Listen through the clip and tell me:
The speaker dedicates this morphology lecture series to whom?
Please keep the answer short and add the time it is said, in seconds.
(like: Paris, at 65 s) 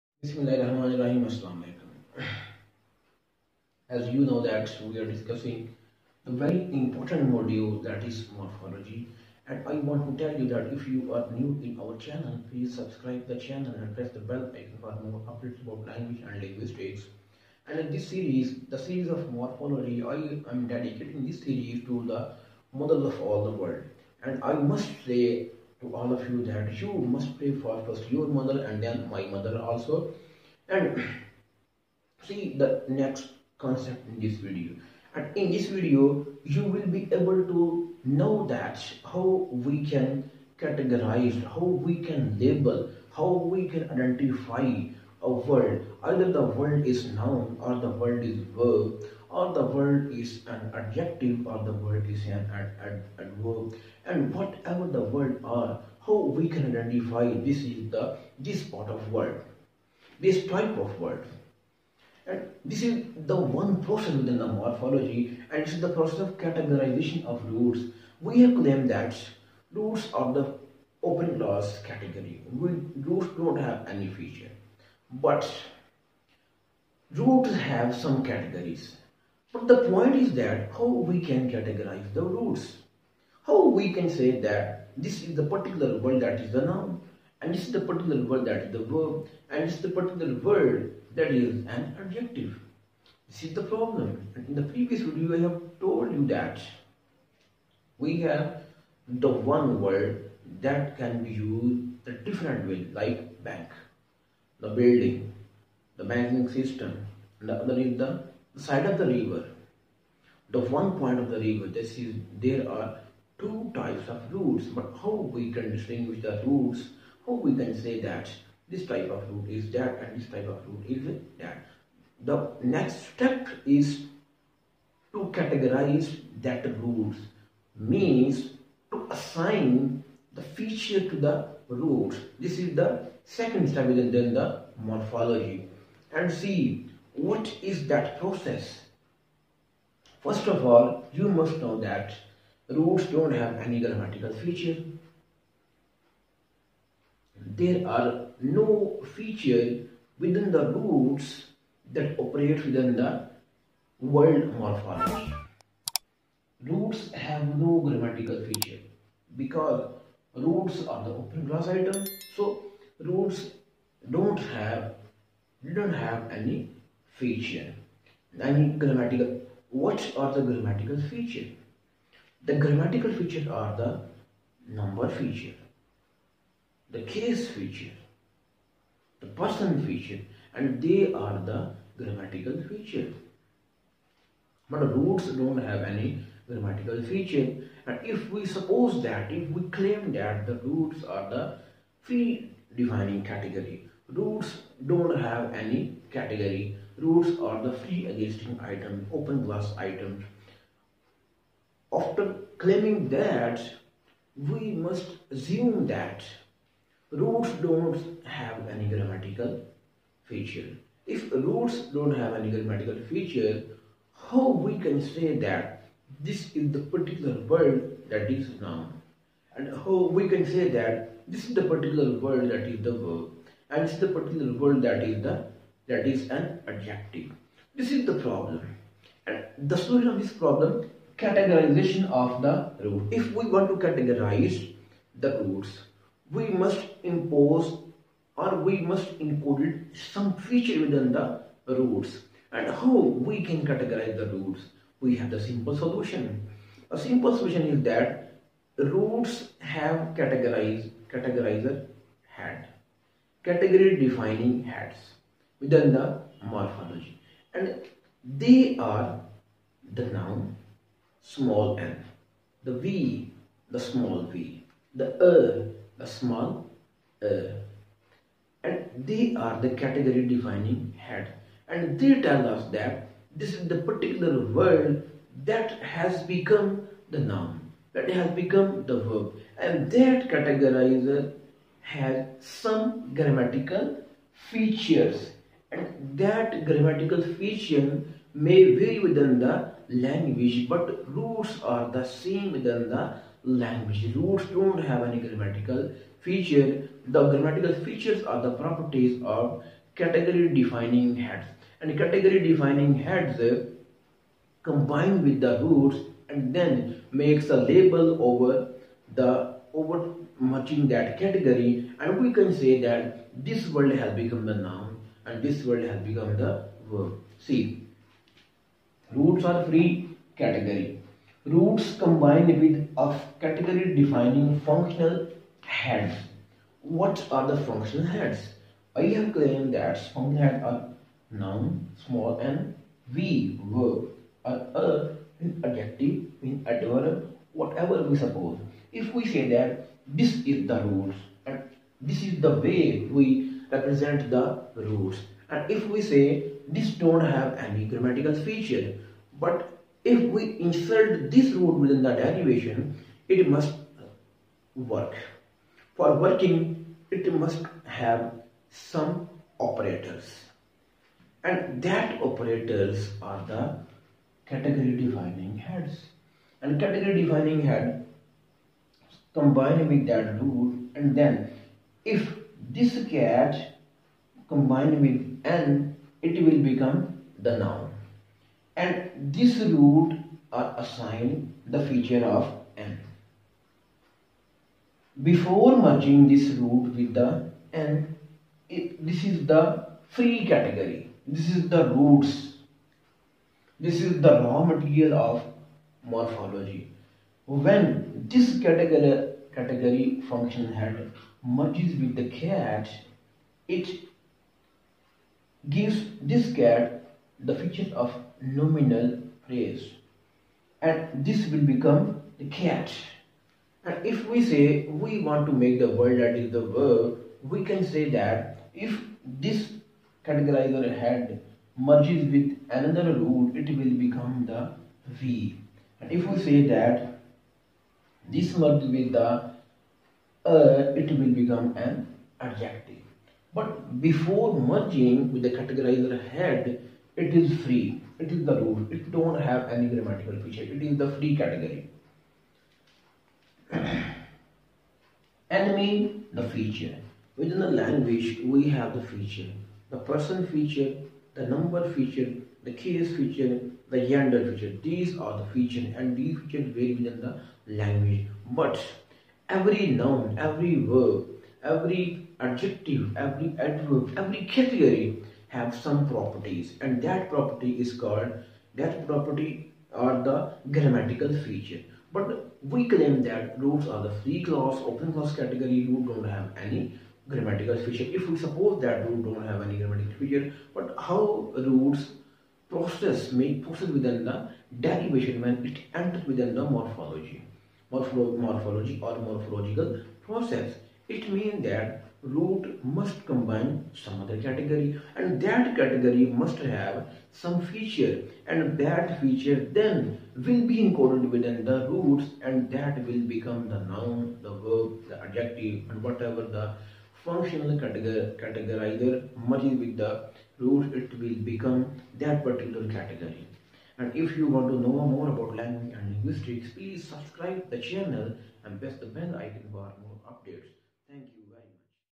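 the models of all the world, at 22 s.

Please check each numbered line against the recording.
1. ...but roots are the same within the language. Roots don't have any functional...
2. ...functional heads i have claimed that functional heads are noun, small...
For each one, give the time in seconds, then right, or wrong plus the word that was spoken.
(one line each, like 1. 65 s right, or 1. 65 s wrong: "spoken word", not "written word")
1. 290 s wrong: "grammatical", not "functional"
2. 327 s right.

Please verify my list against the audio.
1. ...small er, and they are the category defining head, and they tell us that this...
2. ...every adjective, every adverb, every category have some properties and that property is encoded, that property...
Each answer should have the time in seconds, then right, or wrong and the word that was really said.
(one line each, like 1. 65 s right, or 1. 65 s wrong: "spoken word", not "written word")
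1. 266 s right
2. 461 s wrong: "called", not "encoded".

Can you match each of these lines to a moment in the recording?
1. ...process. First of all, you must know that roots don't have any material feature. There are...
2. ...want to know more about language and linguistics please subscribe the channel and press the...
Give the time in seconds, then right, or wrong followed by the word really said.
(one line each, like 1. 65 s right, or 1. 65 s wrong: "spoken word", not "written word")
1. 138 s wrong: "grammatical", not "material"
2. 514 s right.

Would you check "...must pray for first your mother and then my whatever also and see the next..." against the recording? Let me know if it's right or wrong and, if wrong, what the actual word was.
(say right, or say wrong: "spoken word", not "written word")
wrong: "mother", not "whatever".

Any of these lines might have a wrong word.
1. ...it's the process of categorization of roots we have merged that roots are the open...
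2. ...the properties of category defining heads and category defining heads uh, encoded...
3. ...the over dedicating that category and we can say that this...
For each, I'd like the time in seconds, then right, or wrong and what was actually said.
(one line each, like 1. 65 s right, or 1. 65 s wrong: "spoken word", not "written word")
1. 65 s wrong: "claimed", not "merged"
2. 298 s wrong: "combined", not "encoded"
3. 309 s wrong: "matching", not "dedicating".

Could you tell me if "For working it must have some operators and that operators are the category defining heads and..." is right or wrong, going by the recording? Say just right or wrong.
right.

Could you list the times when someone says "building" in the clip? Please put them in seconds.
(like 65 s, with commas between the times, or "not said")
104 s.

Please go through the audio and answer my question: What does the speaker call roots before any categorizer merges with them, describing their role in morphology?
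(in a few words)
raw material.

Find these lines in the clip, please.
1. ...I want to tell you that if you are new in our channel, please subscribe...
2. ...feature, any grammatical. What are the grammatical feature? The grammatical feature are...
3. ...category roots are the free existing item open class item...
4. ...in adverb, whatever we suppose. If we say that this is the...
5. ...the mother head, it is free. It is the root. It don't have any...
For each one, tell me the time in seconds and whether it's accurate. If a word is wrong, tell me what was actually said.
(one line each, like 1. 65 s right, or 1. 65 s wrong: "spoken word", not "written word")
1. 9 s right
2. 167 s right
3. 196 s right
4. 336 s right
5. 435 s wrong: "categorizer", not "mother".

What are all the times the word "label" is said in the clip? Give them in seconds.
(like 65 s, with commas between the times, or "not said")
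42 s, 307 s.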